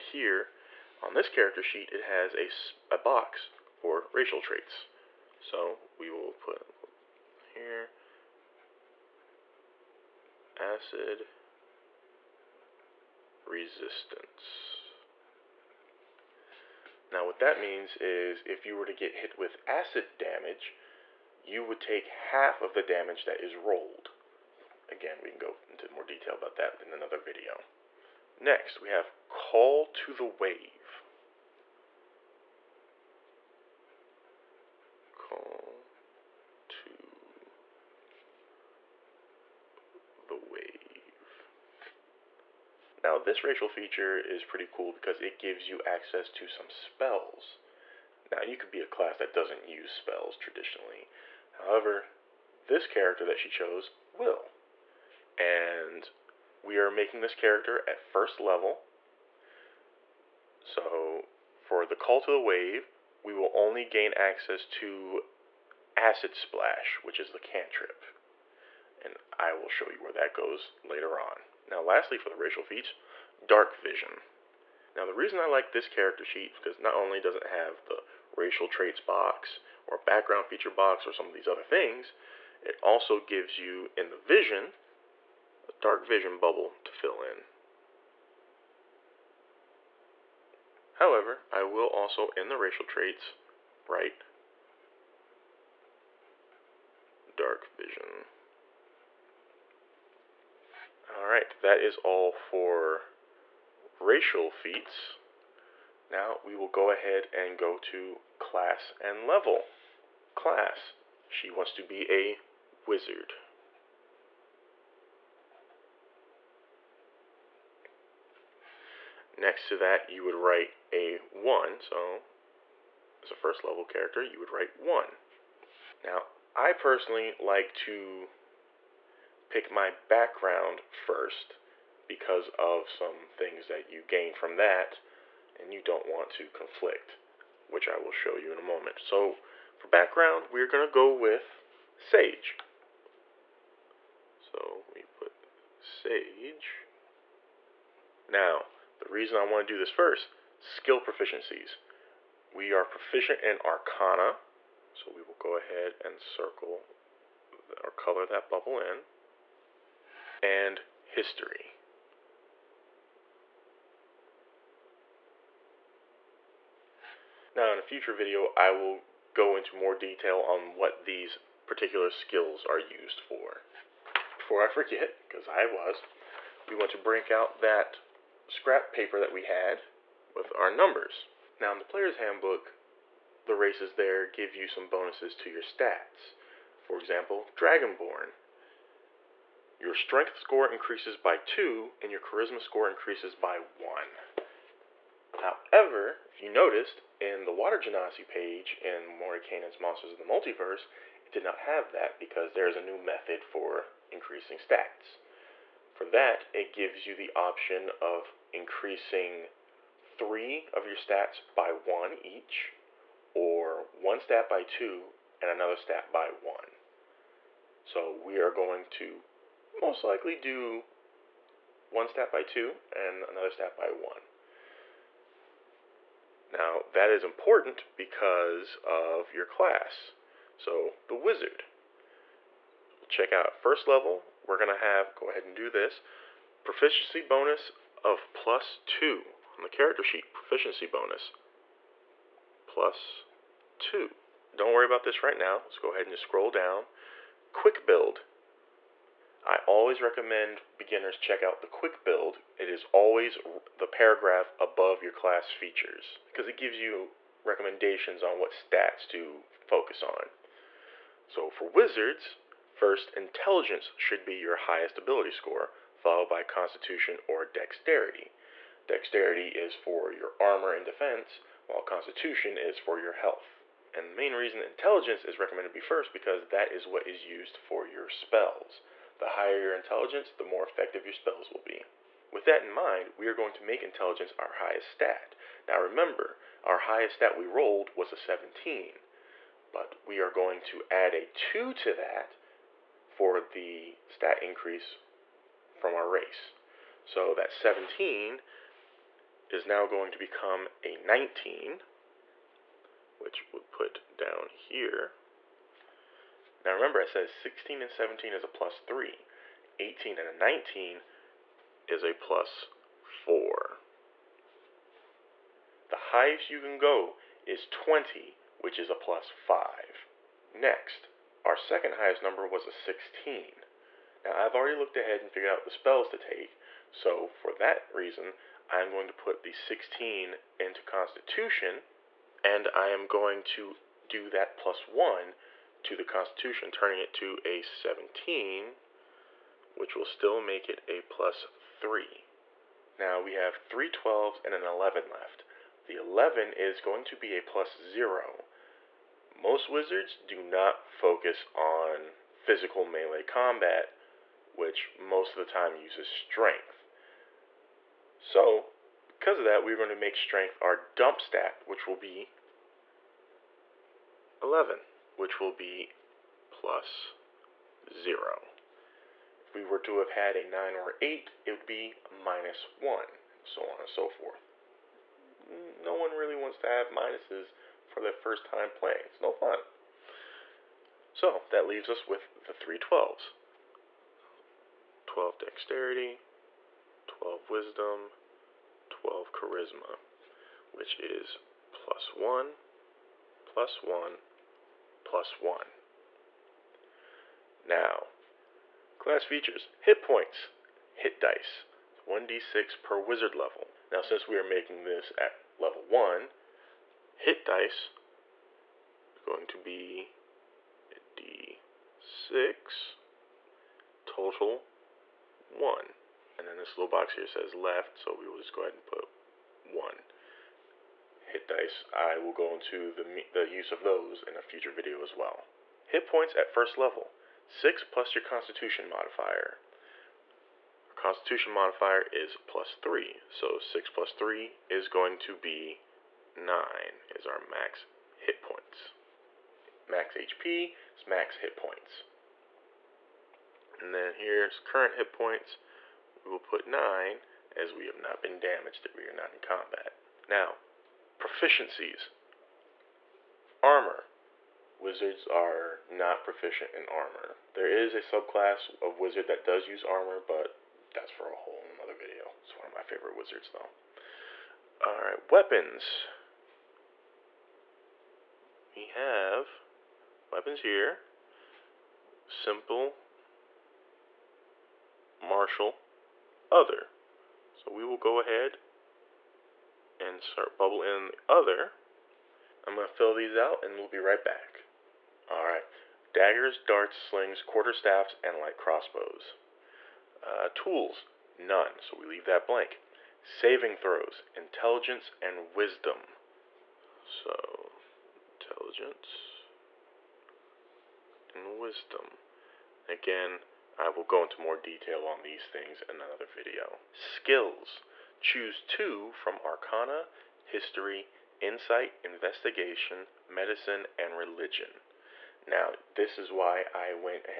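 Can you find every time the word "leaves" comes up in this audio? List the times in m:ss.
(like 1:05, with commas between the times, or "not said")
6:21, 8:12.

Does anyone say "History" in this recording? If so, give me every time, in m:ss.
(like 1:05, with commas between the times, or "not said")
2:41, 8:30.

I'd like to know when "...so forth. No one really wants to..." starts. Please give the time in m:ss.
6:13.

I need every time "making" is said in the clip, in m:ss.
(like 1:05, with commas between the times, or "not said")
0:56, 6:44.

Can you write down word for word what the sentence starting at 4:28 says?
Dexterity is for your armor and defense, while Constitution is for your health.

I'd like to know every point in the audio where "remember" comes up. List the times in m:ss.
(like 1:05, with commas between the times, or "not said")
4:45, 5:06.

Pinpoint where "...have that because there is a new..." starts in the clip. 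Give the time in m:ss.
3:21.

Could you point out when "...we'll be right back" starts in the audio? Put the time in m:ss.
8:03.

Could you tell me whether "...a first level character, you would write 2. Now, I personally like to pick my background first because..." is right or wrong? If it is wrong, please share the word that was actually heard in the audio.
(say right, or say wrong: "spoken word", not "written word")
wrong: "1", not "2".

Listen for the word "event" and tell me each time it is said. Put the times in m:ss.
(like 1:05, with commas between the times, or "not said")
not said.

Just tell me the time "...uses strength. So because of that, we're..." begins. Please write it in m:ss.
5:55.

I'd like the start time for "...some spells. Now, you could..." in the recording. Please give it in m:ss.
0:46.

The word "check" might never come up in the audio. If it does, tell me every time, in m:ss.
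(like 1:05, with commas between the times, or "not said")
3:53, 4:11.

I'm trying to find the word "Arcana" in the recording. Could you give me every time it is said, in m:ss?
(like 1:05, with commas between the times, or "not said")
2:33, 8:29.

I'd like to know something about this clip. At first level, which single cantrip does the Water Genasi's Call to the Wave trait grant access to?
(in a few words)
Acid Splash.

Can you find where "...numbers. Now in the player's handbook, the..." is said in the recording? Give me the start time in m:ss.
3:00.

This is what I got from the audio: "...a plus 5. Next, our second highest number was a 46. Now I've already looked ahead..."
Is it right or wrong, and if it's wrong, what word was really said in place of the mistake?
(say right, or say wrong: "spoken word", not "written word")
wrong: "16", not "46".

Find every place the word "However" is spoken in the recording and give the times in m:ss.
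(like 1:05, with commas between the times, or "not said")
0:51, 1:30, 3:15.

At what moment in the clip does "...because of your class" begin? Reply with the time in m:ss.
3:47.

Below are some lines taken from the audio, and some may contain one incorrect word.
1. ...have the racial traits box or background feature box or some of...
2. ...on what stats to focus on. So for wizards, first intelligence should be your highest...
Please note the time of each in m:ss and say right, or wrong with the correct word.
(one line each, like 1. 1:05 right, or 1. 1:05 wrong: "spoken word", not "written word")
1. 1:17 right
2. 4:18 right.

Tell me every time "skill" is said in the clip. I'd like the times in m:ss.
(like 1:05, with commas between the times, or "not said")
2:30, 2:52, 8:26.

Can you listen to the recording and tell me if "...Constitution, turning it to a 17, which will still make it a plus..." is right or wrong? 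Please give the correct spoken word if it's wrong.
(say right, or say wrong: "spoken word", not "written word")
right.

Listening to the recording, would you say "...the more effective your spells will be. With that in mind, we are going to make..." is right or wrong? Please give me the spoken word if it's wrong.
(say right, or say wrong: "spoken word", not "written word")
right.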